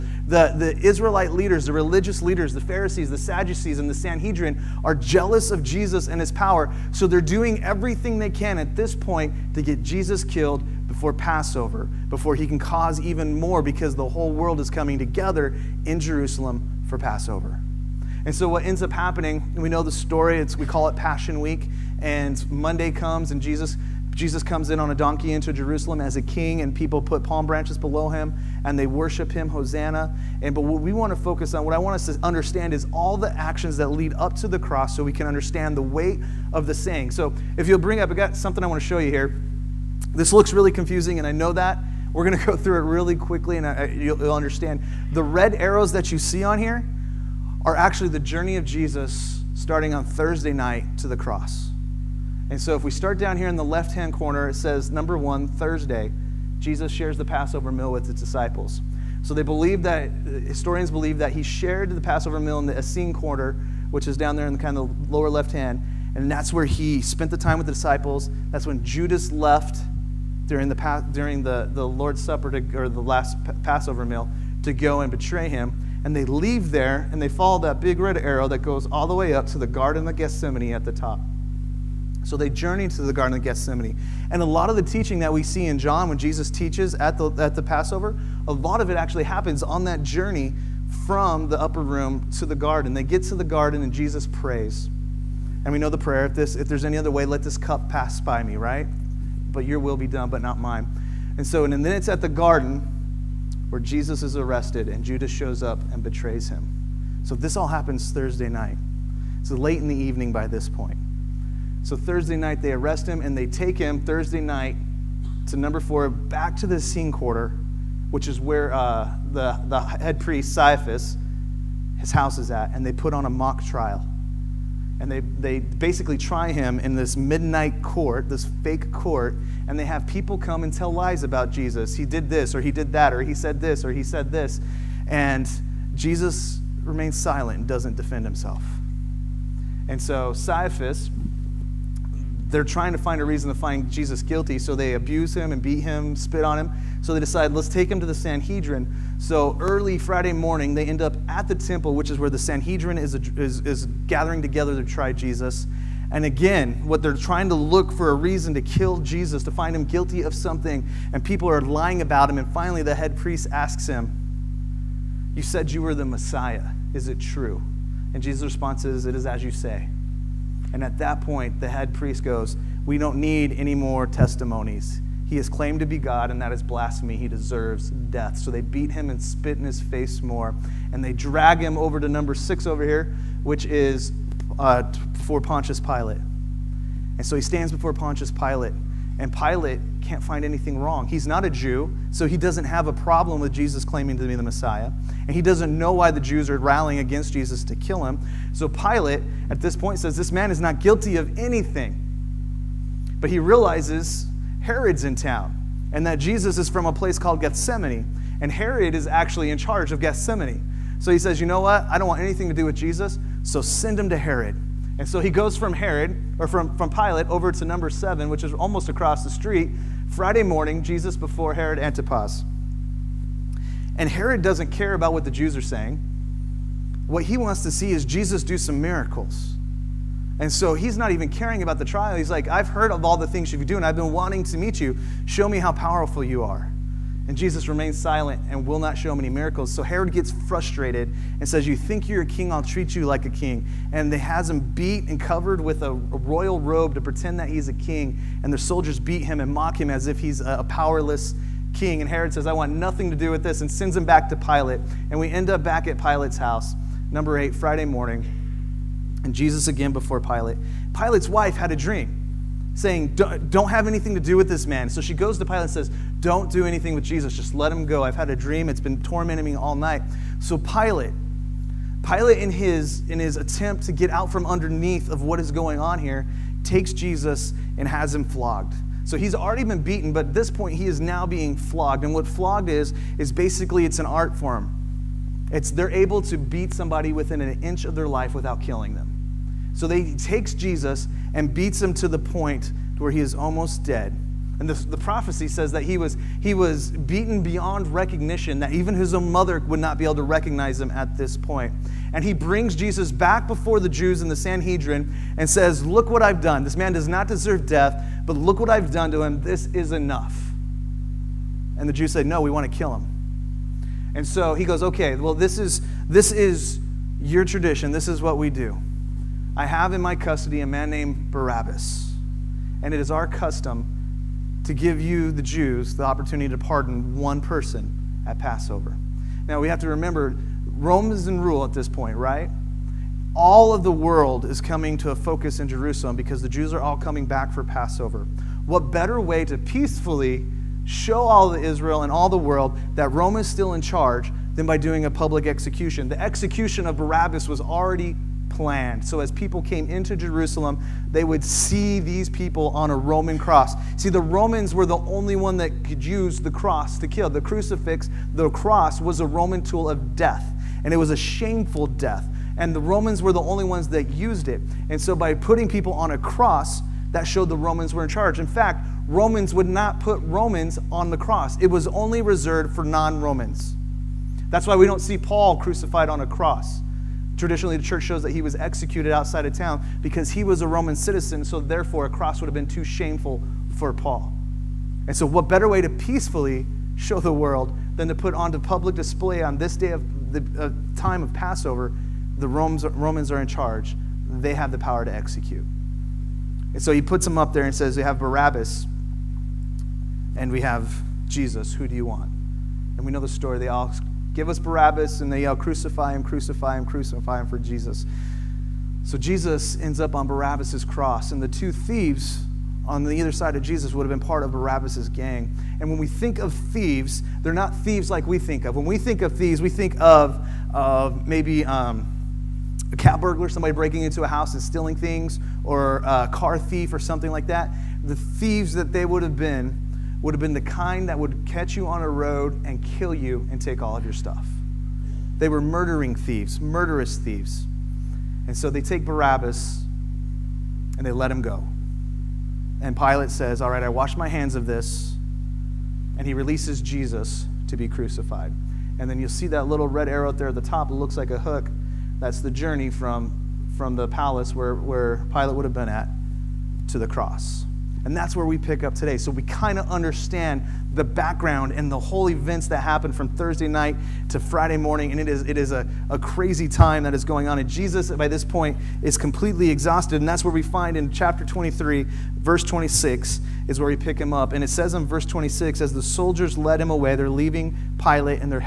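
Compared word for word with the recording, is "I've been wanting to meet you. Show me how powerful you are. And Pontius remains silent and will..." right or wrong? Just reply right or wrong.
wrong.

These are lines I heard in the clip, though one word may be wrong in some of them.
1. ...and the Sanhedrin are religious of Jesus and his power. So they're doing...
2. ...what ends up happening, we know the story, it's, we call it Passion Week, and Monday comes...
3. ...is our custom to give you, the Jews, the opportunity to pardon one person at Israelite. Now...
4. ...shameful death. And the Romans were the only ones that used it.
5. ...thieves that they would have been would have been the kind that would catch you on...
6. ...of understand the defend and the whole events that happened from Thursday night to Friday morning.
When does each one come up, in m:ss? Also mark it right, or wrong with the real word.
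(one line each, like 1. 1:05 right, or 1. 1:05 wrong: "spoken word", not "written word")
1. 0:03 wrong: "jealous", not "religious"
2. 0:18 right
3. 5:22 wrong: "Passover", not "Israelite"
4. 6:01 right
5. 7:08 right
6. 7:39 wrong: "background", not "defend".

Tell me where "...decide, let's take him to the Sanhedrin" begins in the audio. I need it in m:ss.
2:27.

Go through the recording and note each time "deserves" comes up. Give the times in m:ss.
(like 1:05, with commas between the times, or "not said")
2:57, 5:07.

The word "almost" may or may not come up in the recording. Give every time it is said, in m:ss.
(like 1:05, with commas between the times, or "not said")
3:38, 4:53.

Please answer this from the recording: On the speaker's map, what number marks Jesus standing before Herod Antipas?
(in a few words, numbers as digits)
7.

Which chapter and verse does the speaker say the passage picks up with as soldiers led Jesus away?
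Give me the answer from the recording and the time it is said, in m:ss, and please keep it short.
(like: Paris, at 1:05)
Chapter 23, verse 26, at 7:51.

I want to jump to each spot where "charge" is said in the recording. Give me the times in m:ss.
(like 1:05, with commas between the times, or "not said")
3:29, 5:43, 6:08, 6:33.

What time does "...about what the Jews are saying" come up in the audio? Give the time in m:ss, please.
3:44.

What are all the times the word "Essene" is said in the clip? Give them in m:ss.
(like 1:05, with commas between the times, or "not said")
1:02, 1:56.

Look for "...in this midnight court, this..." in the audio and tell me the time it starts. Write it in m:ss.
2:06.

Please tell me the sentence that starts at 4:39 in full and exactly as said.
So he's already been beaten, but at this point he is now being flogged.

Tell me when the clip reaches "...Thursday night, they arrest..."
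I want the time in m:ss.
1:51.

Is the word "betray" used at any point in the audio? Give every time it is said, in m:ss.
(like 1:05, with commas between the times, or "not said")
1:15, 1:46.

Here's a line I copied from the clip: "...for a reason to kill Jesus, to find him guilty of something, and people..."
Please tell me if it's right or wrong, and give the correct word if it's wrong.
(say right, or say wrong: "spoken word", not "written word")
right.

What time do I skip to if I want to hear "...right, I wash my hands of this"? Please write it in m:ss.
7:23.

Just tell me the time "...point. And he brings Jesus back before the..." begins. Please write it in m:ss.
5:01.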